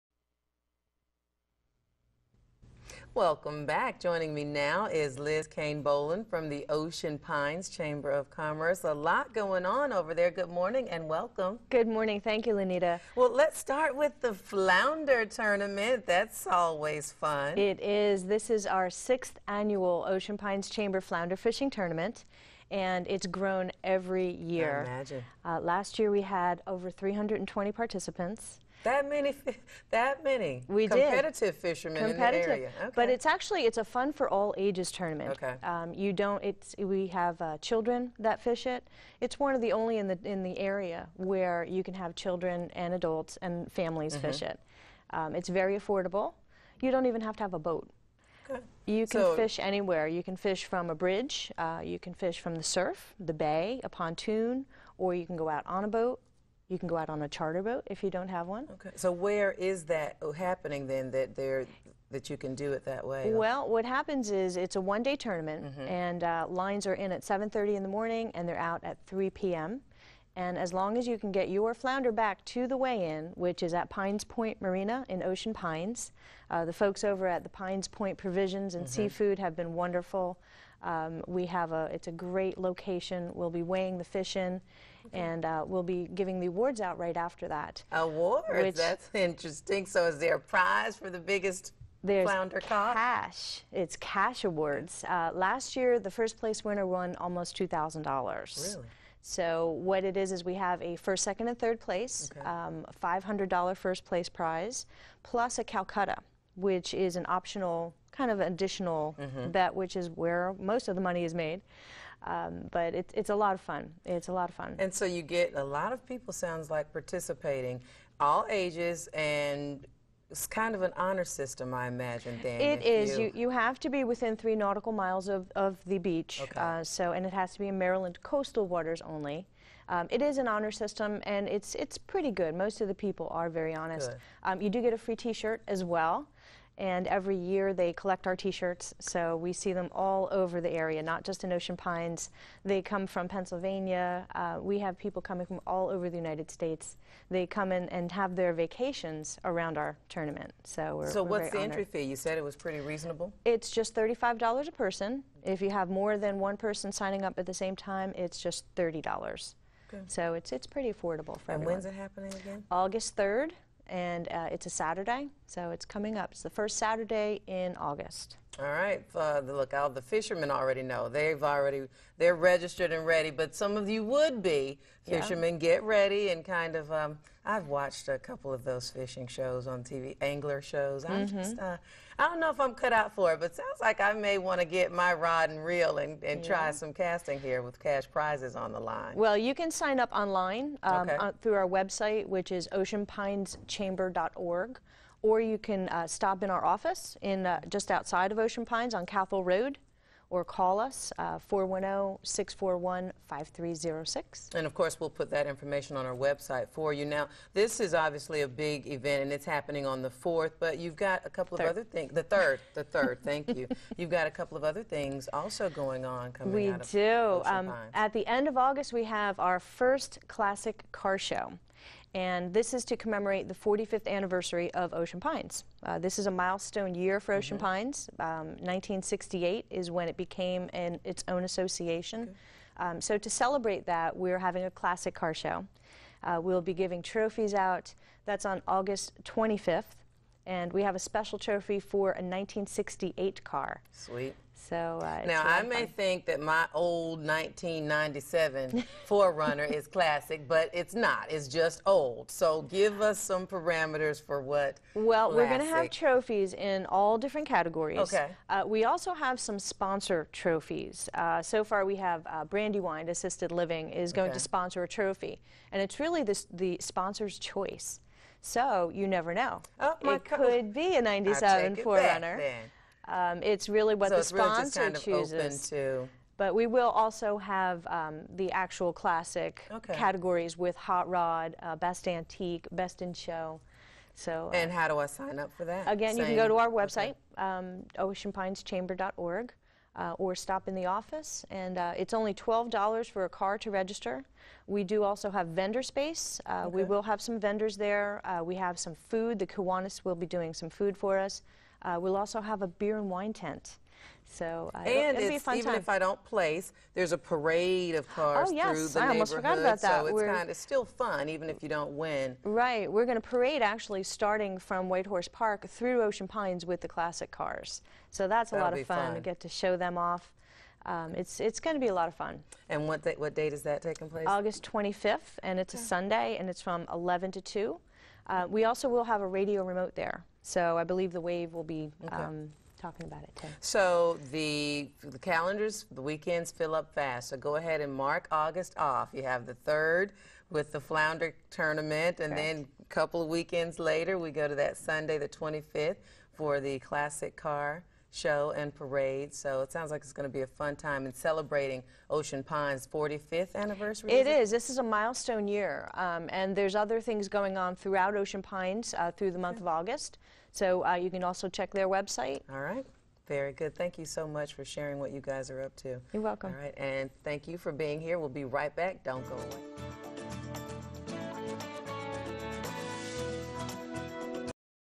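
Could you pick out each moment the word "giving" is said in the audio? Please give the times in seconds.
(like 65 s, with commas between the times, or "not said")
86 s, 236 s.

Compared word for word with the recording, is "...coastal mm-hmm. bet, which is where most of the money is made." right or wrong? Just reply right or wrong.
wrong.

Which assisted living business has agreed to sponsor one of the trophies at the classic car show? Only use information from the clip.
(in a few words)
Brandywine Assisted Living.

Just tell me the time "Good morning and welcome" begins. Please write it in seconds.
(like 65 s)
10 s.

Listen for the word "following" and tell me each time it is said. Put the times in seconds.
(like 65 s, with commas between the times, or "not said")
not said.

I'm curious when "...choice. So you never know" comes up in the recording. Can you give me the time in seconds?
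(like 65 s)
267 s.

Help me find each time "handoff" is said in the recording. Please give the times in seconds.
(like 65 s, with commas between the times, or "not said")
not said.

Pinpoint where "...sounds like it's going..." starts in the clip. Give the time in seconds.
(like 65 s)
349 s.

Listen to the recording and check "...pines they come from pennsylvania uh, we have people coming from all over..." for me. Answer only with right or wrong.
right.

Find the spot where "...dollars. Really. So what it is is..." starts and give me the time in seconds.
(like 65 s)
98 s.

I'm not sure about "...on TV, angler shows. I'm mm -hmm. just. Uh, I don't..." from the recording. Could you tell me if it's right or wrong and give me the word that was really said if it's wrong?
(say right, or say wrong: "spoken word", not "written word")
right.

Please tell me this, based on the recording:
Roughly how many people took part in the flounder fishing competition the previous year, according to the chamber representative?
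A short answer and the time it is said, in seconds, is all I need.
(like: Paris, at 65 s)
over 320, at 26 s.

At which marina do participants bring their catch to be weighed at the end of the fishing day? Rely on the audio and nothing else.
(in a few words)
Pines Point Marina.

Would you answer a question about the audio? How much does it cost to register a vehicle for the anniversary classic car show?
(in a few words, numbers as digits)
$12.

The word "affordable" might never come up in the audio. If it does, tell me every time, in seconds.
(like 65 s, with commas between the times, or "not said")
45 s, 160 s.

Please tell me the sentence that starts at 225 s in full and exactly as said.
Uh, this is a milestone year for Ocean mm -hmm.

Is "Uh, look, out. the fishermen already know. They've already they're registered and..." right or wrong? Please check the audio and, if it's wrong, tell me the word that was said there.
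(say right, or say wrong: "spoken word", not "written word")
right.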